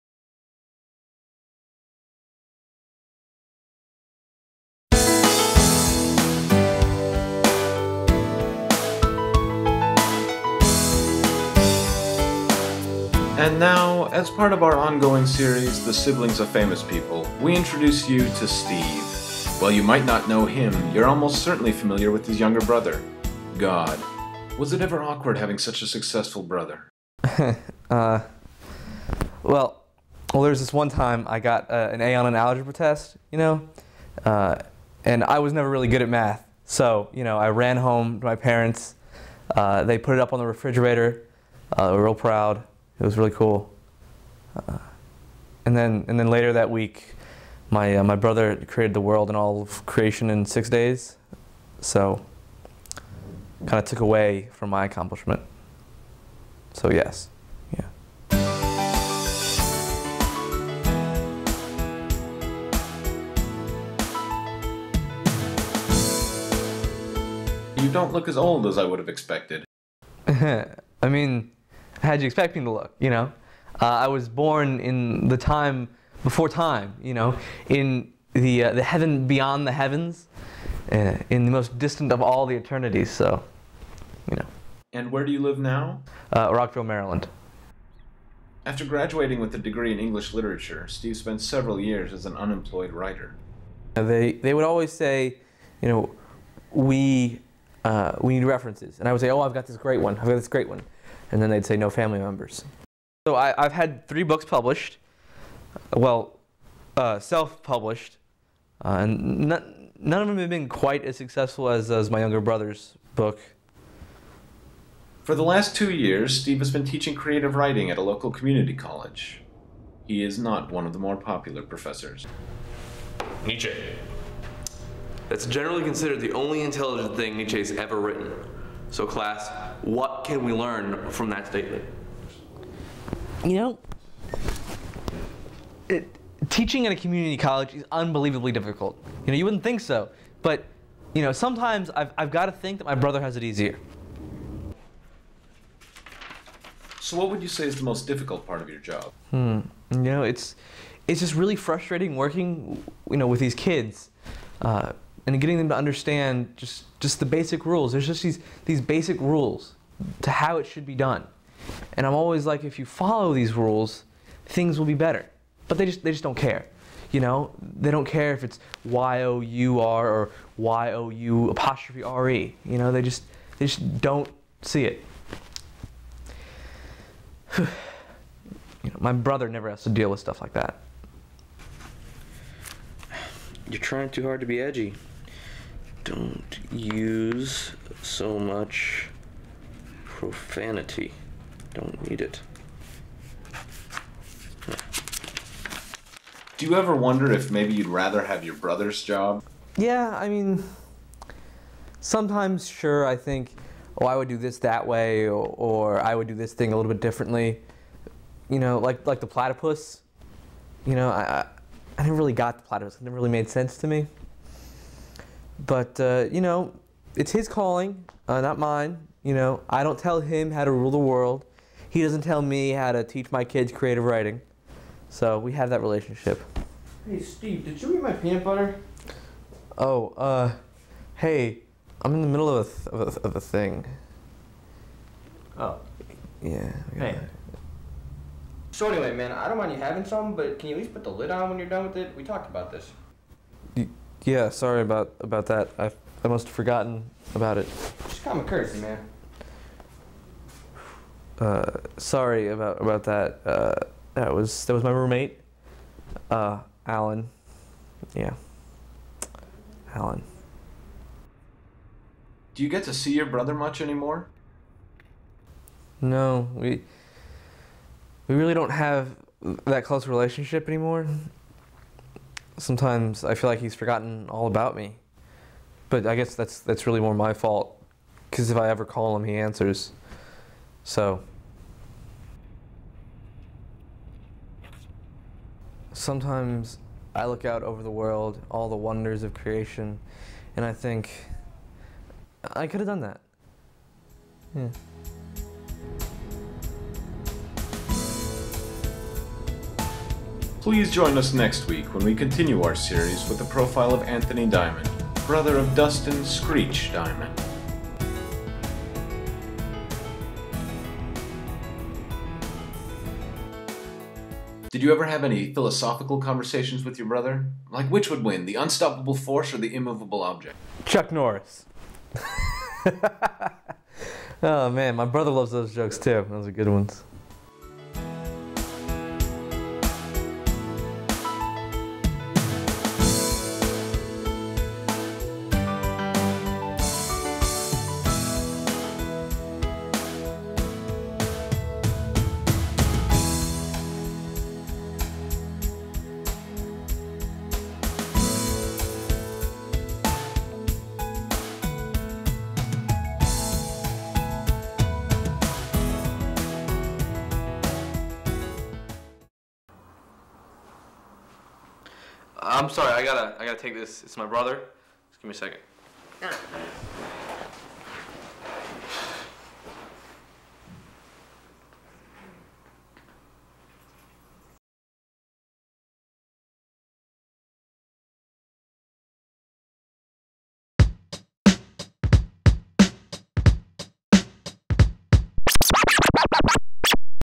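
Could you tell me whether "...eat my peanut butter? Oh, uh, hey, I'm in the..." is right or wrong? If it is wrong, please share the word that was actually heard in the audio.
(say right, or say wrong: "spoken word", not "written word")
right.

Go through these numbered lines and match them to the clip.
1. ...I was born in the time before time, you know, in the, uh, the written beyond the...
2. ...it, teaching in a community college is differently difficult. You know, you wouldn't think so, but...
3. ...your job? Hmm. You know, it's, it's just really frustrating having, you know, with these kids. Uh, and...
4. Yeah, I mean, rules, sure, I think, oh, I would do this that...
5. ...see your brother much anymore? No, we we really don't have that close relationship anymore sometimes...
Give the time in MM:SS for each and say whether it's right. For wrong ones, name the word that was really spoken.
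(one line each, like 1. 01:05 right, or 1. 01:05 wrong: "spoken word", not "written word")
1. 01:13 wrong: "heaven", not "written"
2. 02:15 wrong: "unbelievably", not "differently"
3. 02:28 wrong: "working", not "having"
4. 03:19 wrong: "sometimes", not "rules"
5. 04:22 right.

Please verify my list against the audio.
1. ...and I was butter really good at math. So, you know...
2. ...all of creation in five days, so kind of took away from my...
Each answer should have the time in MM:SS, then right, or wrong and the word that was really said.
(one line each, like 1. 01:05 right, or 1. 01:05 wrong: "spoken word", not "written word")
1. 00:35 wrong: "never", not "butter"
2. 00:49 wrong: "six", not "five".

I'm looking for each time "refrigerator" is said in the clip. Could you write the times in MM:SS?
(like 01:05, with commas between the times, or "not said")
00:40.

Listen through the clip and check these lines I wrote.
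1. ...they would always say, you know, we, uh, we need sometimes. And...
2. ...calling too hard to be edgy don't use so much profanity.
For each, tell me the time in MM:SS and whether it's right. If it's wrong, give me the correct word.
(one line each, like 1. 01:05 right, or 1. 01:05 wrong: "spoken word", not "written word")
1. 01:34 wrong: "references", not "sometimes"
2. 03:03 wrong: "trying", not "calling".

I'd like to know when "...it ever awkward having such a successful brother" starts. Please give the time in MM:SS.
00:24.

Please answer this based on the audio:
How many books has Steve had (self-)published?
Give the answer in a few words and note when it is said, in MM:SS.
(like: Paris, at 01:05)
3, at 01:44.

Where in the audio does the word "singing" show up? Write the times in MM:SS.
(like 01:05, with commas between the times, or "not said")
not said.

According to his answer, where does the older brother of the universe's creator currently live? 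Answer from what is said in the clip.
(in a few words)
Rockville, Maryland.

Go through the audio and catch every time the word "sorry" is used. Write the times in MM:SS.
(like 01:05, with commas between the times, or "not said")
04:04, 04:11, 06:02.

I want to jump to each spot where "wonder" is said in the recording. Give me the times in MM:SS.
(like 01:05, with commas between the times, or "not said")
03:16, 04:48.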